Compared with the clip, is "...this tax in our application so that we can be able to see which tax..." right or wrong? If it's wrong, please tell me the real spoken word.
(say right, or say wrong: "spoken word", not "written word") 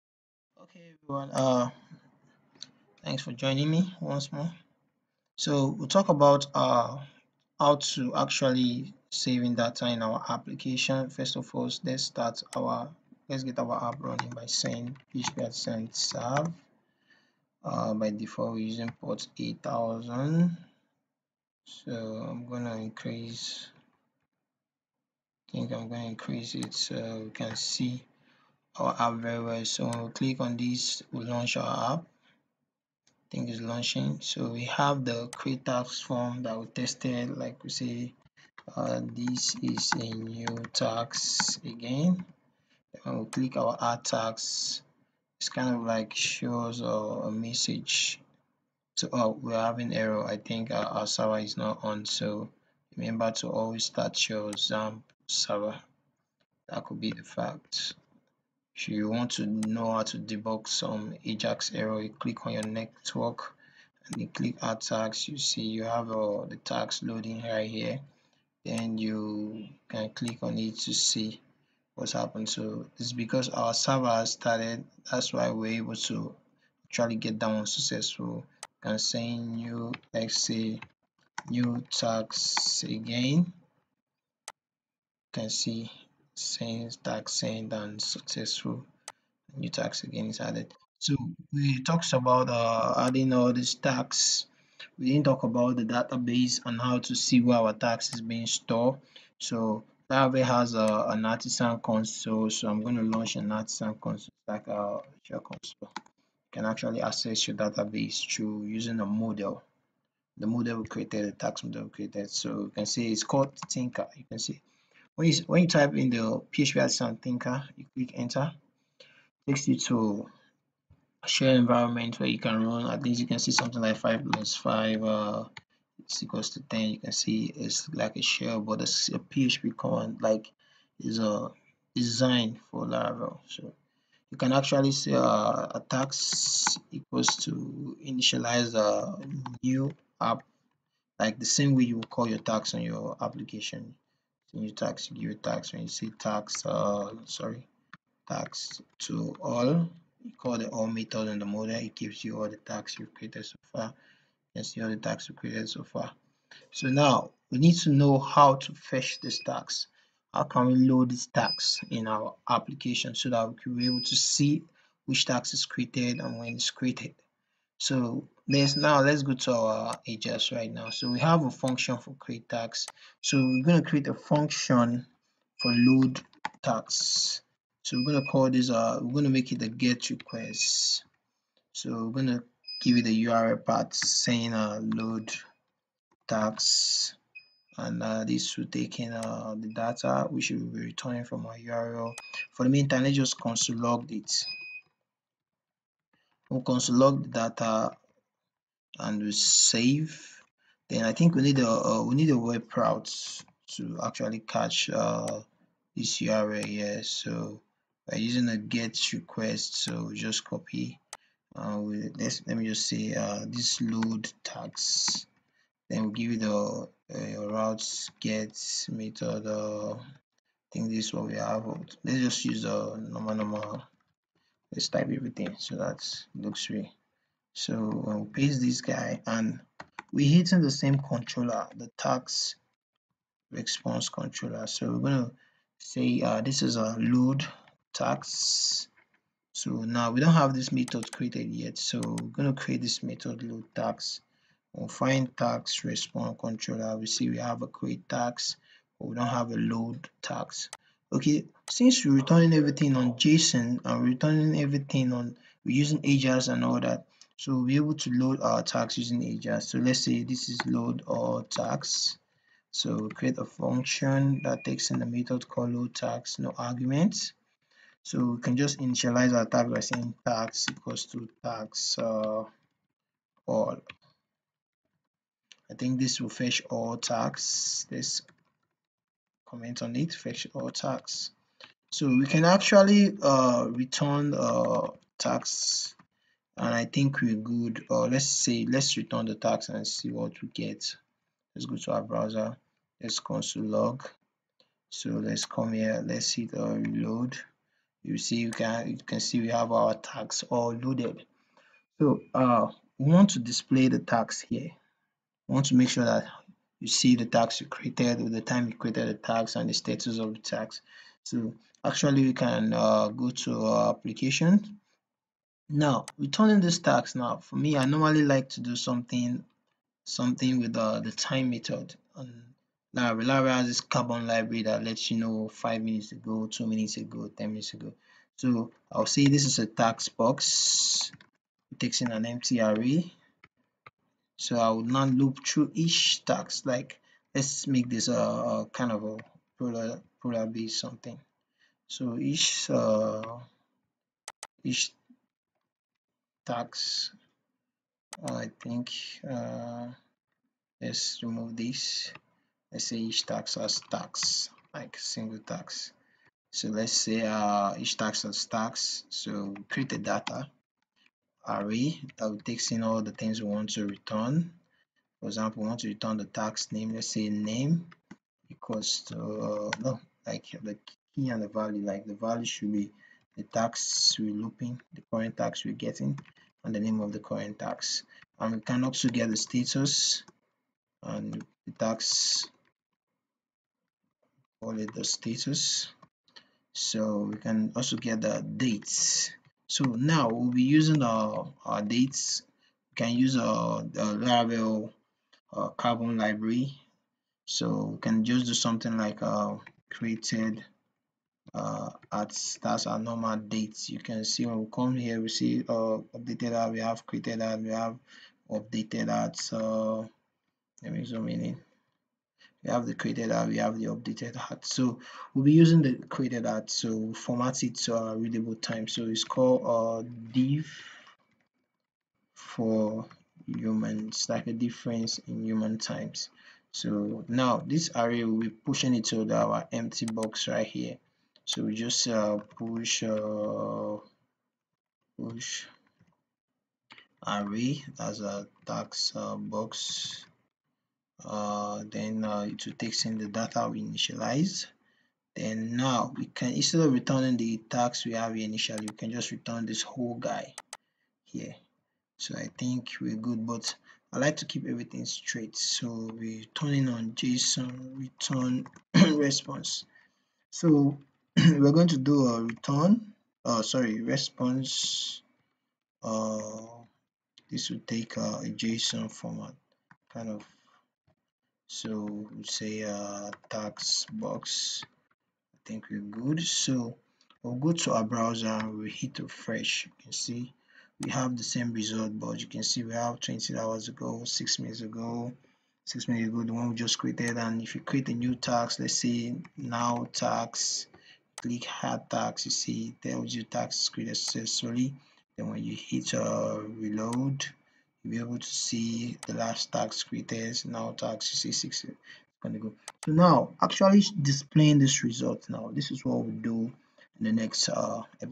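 right.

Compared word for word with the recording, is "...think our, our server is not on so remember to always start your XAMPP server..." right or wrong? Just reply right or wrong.
right.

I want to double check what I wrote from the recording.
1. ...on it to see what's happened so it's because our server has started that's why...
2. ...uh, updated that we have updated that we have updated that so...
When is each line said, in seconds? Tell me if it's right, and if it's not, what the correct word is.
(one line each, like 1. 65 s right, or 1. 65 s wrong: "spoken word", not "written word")
1. 70 s right
2. 405 s wrong: "created", not "updated".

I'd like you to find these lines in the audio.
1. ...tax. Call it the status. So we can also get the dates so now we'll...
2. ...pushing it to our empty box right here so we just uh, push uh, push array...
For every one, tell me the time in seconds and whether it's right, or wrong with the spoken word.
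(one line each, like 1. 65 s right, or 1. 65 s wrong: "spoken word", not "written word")
1. 381 s right
2. 428 s right.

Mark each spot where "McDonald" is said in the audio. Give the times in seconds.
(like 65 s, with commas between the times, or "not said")
not said.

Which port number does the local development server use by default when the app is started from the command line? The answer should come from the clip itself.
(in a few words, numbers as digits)
8000.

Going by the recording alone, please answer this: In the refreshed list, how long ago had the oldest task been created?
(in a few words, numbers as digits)
20 hours ago.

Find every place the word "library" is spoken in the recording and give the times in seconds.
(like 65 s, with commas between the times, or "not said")
324 s, 396 s.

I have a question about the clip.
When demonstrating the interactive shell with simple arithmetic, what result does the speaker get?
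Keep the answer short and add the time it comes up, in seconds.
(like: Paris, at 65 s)
10, at 126 s.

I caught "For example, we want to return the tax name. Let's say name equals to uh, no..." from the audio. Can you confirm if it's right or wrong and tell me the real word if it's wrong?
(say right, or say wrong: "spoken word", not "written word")
right.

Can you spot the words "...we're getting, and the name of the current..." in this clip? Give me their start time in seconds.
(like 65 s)
375 s.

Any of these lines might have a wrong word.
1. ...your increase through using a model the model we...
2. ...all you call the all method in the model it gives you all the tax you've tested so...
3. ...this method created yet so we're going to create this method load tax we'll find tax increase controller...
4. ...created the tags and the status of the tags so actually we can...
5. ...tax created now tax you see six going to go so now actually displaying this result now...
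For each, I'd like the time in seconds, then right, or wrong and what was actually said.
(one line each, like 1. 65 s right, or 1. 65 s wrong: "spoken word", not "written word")
1. 107 s wrong: "database", not "increase"
2. 149 s wrong: "created", not "tested"
3. 240 s wrong: "response", not "increase"
4. 308 s right
5. 499 s right.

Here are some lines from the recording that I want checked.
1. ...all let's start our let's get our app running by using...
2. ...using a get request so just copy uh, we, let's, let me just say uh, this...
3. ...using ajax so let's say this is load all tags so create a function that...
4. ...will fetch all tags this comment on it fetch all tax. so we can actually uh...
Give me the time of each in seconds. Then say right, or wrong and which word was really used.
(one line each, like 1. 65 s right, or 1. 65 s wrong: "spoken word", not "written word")
1. 11 s wrong: "saying", not "using"
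2. 208 s right
3. 258 s right
4. 276 s right.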